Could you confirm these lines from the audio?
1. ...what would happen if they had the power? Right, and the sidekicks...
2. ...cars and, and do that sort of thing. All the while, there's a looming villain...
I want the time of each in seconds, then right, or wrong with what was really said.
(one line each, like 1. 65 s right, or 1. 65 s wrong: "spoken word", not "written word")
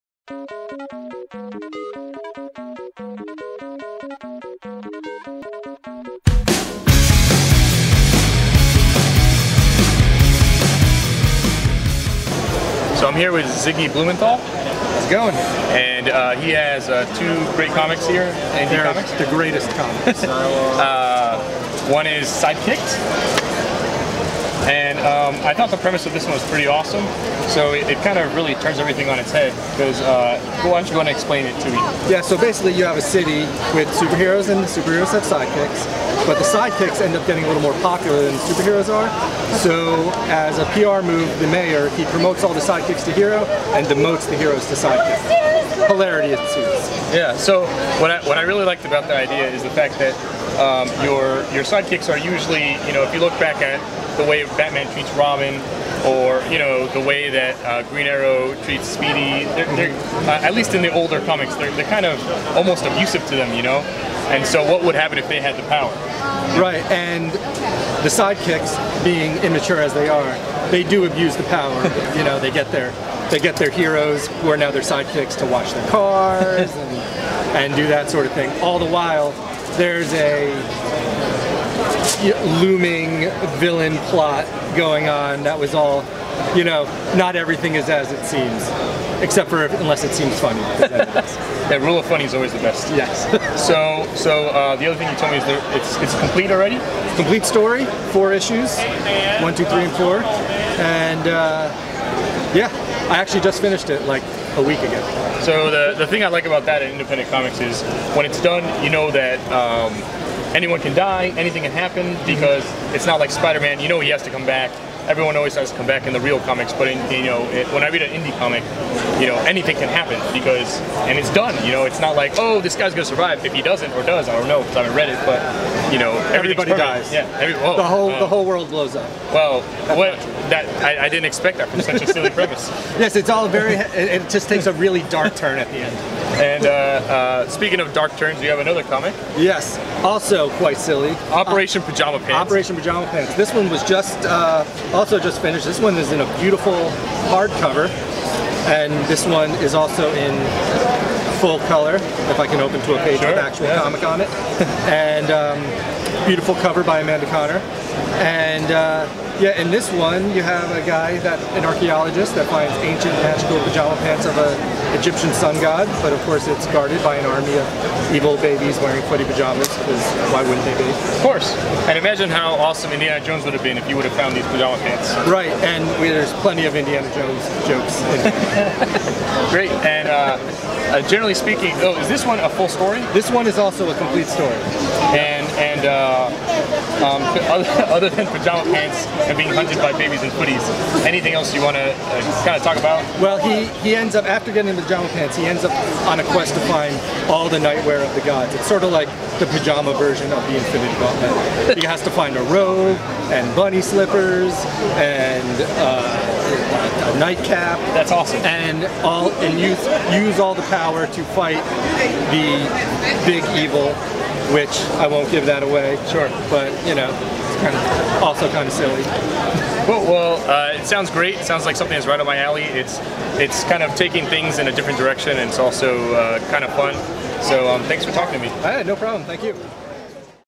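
1. 64 s right
2. 75 s right.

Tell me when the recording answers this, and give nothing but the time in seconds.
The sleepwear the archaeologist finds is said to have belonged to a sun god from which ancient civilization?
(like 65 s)
164 s.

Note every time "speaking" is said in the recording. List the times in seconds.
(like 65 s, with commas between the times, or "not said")
137 s, 181 s.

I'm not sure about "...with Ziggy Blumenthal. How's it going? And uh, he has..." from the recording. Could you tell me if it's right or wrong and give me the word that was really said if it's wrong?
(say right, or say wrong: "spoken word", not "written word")
right.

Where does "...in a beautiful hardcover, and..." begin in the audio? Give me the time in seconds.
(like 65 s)
146 s.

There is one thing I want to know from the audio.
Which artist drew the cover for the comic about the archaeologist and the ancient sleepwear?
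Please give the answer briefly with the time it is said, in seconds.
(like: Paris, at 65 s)
Amanda Conner, at 157 s.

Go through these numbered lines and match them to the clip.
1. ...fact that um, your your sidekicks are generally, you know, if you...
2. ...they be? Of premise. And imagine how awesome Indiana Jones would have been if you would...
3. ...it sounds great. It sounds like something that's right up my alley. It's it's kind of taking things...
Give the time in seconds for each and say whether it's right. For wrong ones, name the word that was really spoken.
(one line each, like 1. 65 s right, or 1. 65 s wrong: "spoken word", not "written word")
1. 49 s wrong: "usually", not "generally"
2. 170 s wrong: "course", not "premise"
3. 220 s right.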